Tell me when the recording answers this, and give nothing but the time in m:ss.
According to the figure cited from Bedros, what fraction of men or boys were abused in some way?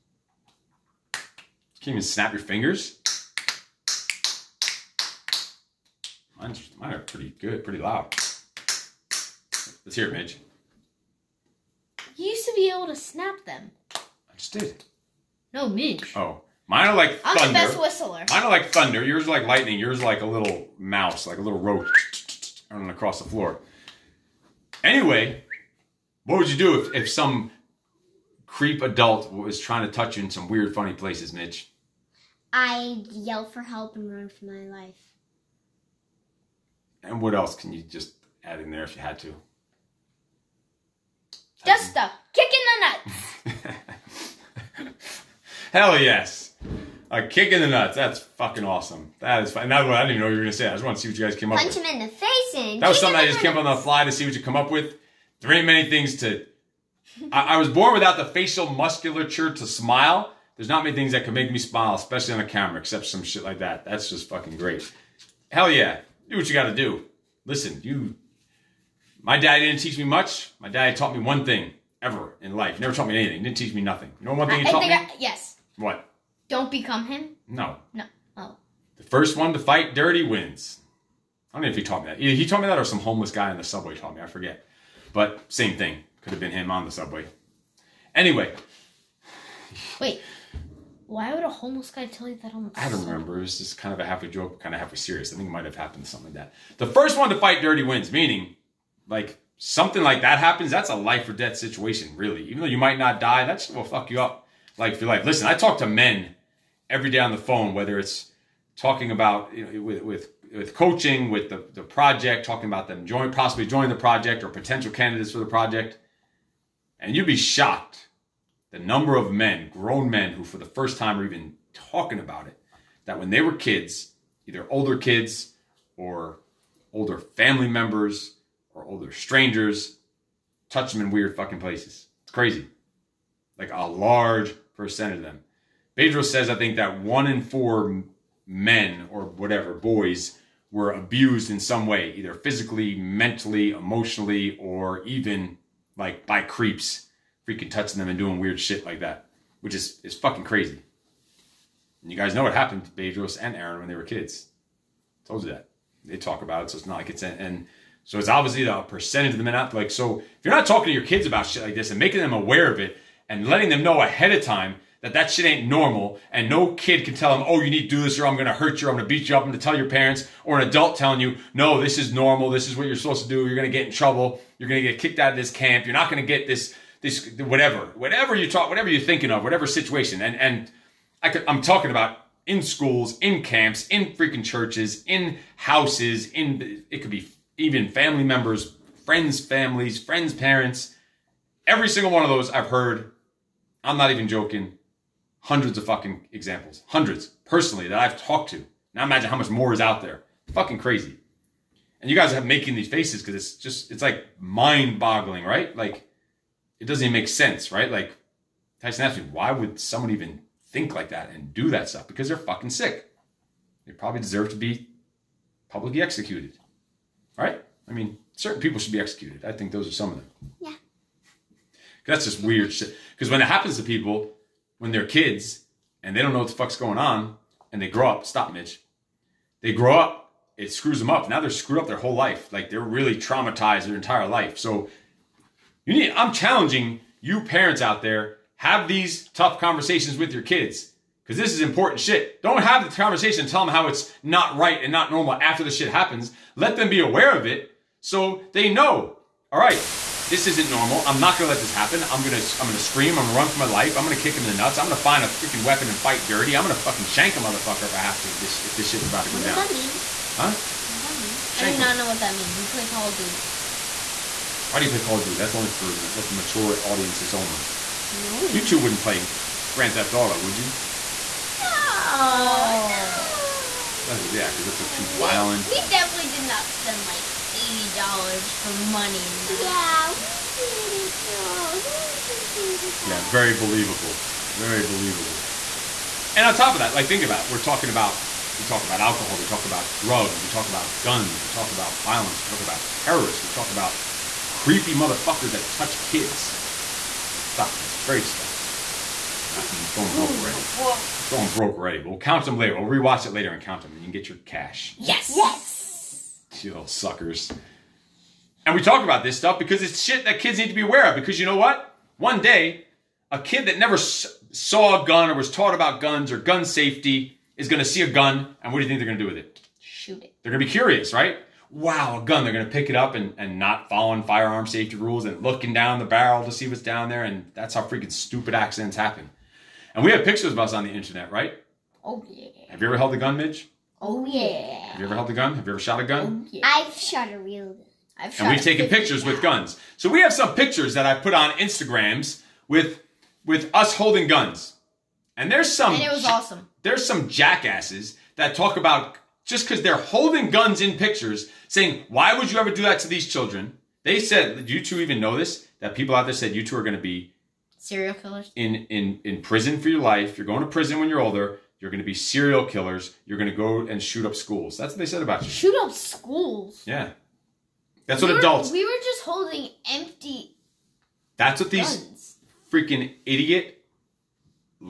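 2:16.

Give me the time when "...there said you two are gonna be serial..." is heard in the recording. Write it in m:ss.
5:56.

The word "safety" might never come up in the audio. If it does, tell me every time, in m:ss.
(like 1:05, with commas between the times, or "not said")
5:16, 5:24.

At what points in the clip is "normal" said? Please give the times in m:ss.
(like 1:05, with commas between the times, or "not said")
2:45, 2:52, 4:05, 4:10.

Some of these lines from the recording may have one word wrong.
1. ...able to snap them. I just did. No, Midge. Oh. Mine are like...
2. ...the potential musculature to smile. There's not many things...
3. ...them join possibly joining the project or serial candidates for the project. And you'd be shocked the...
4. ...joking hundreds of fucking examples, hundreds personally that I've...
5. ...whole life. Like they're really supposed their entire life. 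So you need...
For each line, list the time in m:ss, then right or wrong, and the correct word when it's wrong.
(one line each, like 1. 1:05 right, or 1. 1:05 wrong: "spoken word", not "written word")
1. 0:12 right
2. 0:58 wrong: "facial", not "potential"
3. 1:52 wrong: "potential", not "serial"
4. 3:14 right
5. 3:51 wrong: "traumatized", not "supposed".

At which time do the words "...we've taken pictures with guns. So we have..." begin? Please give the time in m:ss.
5:38.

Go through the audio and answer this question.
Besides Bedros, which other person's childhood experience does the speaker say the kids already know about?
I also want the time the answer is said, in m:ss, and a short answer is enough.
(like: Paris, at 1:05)
Aaron, at 2:33.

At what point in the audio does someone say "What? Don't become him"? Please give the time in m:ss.
1:15.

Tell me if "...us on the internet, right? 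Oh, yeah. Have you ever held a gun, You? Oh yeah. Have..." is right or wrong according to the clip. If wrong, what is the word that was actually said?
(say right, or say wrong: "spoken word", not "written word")
wrong: "Midge", not "You".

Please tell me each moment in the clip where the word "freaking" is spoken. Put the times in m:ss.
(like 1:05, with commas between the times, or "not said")
2:27, 3:04, 4:15, 5:27, 6:12.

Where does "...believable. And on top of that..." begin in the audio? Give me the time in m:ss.
4:44.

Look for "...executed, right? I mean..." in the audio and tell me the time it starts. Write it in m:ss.
3:36.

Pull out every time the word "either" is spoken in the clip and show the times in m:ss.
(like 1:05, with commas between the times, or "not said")
1:22, 2:04, 2:22.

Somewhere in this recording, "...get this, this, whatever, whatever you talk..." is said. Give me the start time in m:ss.
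2:56.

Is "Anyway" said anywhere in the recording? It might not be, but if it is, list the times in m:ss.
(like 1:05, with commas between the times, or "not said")
0:24, 1:28.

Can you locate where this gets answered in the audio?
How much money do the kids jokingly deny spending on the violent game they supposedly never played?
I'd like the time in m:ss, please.
4:37.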